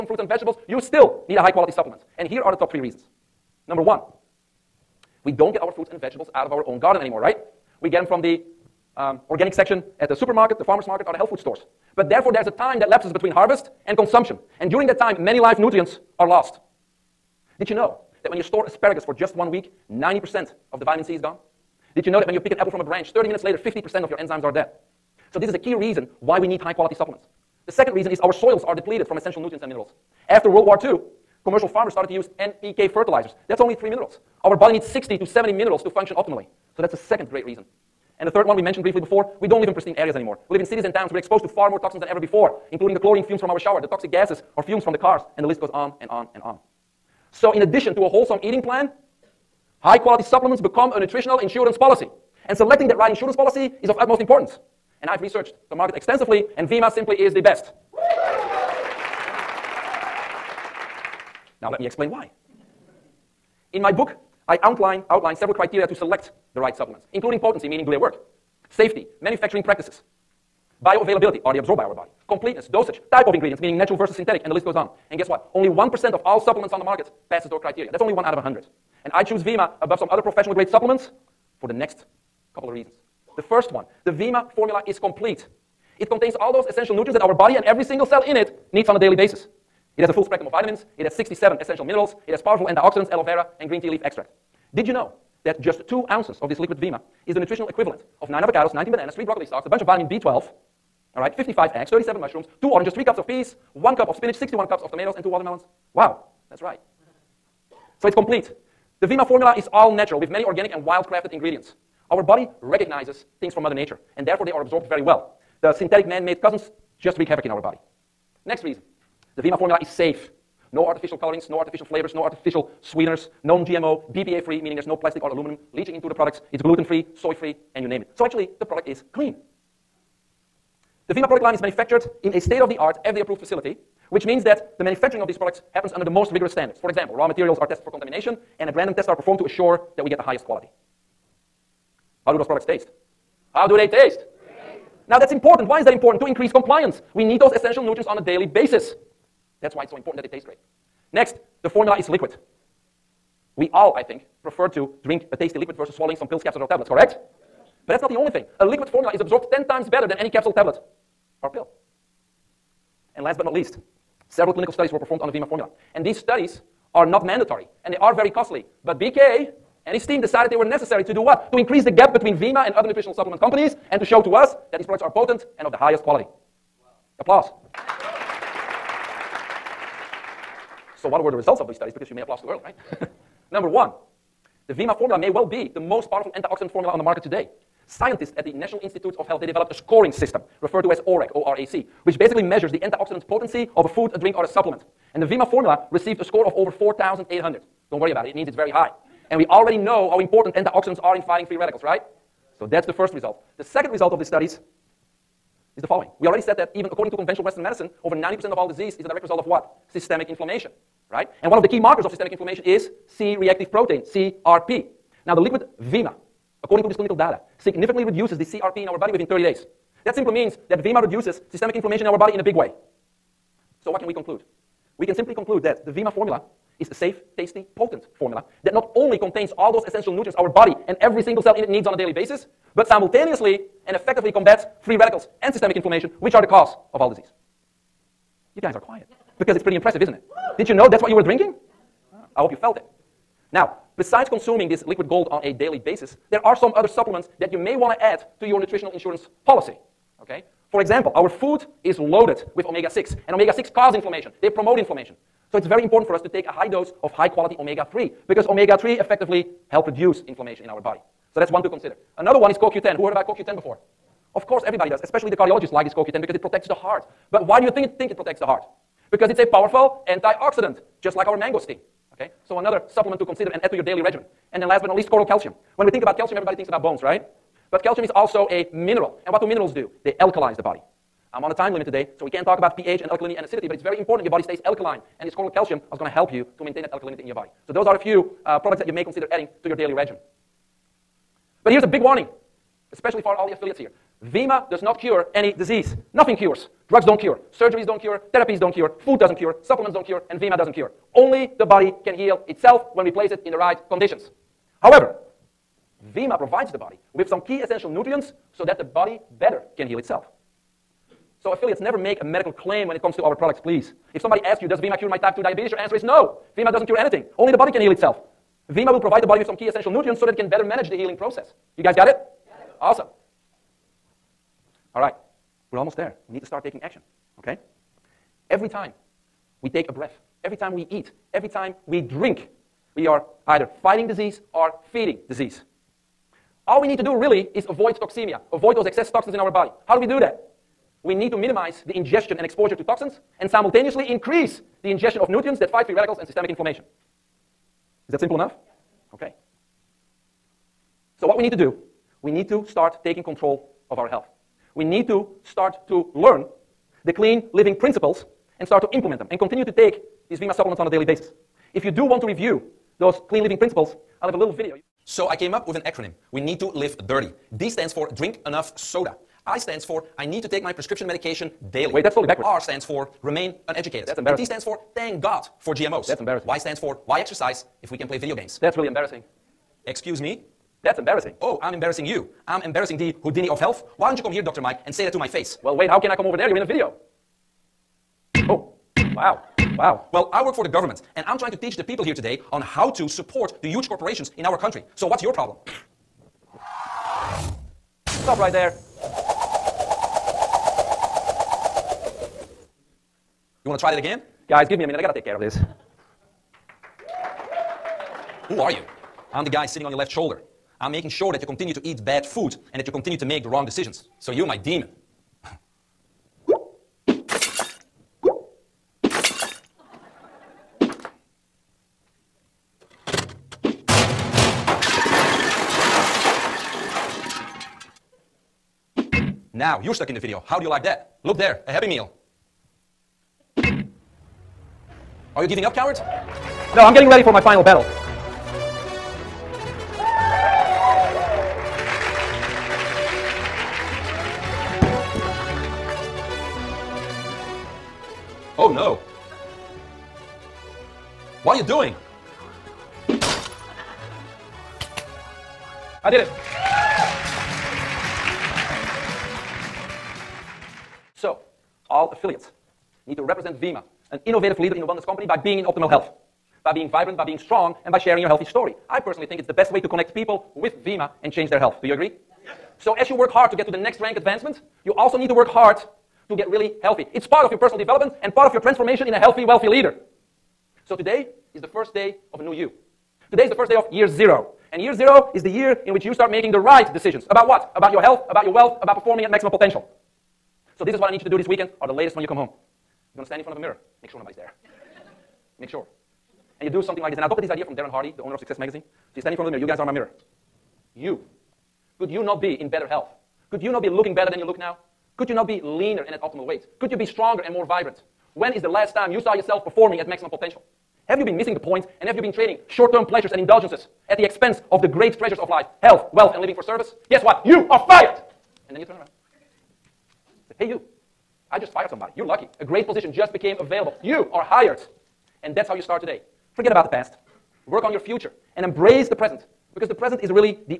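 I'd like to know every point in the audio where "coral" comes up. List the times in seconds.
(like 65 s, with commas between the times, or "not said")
275 s, 285 s.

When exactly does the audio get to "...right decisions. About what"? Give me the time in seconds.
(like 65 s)
486 s.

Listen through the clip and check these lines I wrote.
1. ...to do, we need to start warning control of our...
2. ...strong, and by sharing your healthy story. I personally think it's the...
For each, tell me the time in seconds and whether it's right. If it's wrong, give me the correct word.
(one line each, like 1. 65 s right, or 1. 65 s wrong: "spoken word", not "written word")
1. 351 s wrong: "taking", not "warning"
2. 467 s right.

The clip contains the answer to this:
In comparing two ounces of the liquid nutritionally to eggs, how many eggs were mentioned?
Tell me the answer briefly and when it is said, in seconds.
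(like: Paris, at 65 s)
55, at 101 s.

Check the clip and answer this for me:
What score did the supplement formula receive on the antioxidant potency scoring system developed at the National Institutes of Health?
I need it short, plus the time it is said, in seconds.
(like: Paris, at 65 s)
over 4,800, at 196 s.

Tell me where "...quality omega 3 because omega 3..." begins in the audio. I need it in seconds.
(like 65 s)
257 s.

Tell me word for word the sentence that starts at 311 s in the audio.
So, affiliates, never make a medical claim when it comes to our products, please.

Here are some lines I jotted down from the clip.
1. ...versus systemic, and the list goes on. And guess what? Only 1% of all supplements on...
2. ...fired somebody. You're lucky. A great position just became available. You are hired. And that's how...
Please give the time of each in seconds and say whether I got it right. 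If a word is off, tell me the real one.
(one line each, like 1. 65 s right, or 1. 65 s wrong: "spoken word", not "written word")
1. 73 s wrong: "synthetic", not "systemic"
2. 521 s right.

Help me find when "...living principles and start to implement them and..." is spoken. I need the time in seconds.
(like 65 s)
357 s.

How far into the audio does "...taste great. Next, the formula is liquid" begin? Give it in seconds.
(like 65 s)
150 s.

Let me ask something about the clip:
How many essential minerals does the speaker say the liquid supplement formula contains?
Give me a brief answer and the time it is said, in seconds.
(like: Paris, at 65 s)
67, at 91 s.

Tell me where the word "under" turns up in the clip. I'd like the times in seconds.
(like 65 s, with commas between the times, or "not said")
135 s.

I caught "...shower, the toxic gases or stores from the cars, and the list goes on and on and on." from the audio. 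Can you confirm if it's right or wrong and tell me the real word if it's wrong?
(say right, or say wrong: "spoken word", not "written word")
wrong: "fumes", not "stores".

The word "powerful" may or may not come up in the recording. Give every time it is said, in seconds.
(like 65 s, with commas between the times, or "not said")
92 s, 186 s, 269 s.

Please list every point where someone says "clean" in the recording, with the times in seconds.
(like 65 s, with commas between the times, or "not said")
129 s, 357 s, 363 s.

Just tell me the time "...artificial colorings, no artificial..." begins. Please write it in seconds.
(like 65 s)
120 s.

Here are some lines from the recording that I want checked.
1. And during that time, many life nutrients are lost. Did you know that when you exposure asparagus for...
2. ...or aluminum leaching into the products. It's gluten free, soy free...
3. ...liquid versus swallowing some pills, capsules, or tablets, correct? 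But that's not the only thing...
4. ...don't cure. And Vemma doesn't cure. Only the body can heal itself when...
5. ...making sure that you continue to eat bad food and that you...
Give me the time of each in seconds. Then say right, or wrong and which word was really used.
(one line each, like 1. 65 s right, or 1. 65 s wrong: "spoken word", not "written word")
1. 14 s wrong: "store", not "exposure"
2. 125 s right
3. 155 s right
4. 299 s right
5. 410 s right.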